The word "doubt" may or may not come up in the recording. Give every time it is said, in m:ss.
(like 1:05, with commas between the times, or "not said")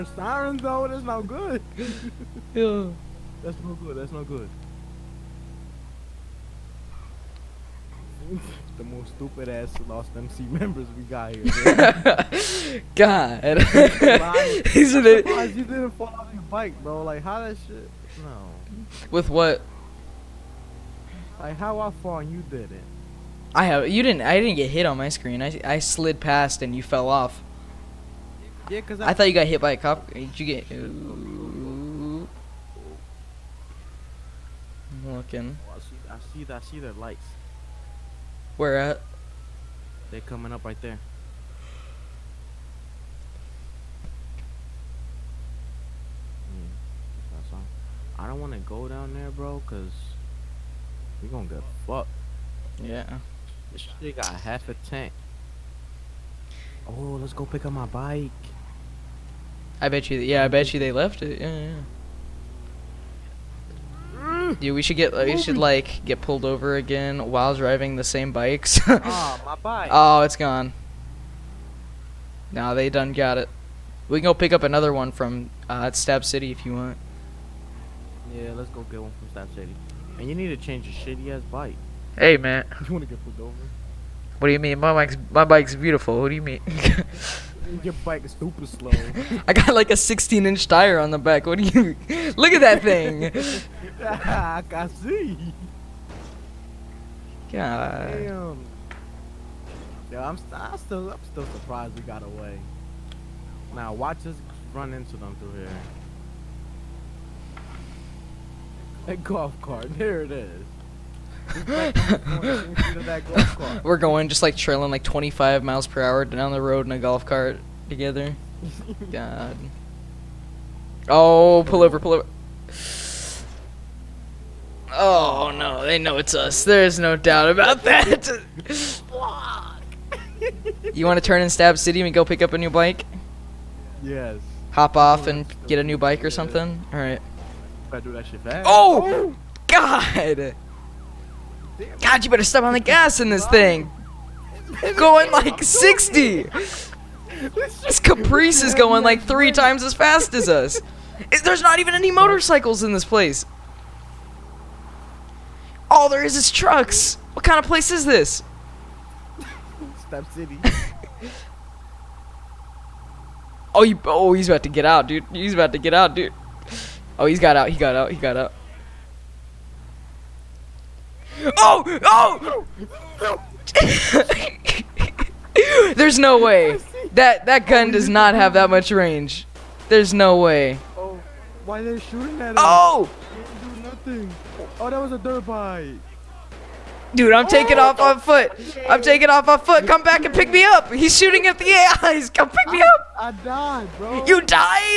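2:07.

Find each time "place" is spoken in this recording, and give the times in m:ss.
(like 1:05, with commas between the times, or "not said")
2:33, 2:37.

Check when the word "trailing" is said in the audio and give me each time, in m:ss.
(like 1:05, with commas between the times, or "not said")
1:54.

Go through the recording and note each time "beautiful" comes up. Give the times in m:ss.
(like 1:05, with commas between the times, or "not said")
1:25.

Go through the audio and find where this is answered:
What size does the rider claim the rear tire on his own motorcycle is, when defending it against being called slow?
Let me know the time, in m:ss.
1:29.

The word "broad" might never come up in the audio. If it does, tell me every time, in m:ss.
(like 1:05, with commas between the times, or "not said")
not said.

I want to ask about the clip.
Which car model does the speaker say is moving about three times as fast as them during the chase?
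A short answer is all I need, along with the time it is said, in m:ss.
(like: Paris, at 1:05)
Caprice, at 2:28.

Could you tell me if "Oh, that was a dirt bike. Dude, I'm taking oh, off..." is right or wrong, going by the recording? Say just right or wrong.
right.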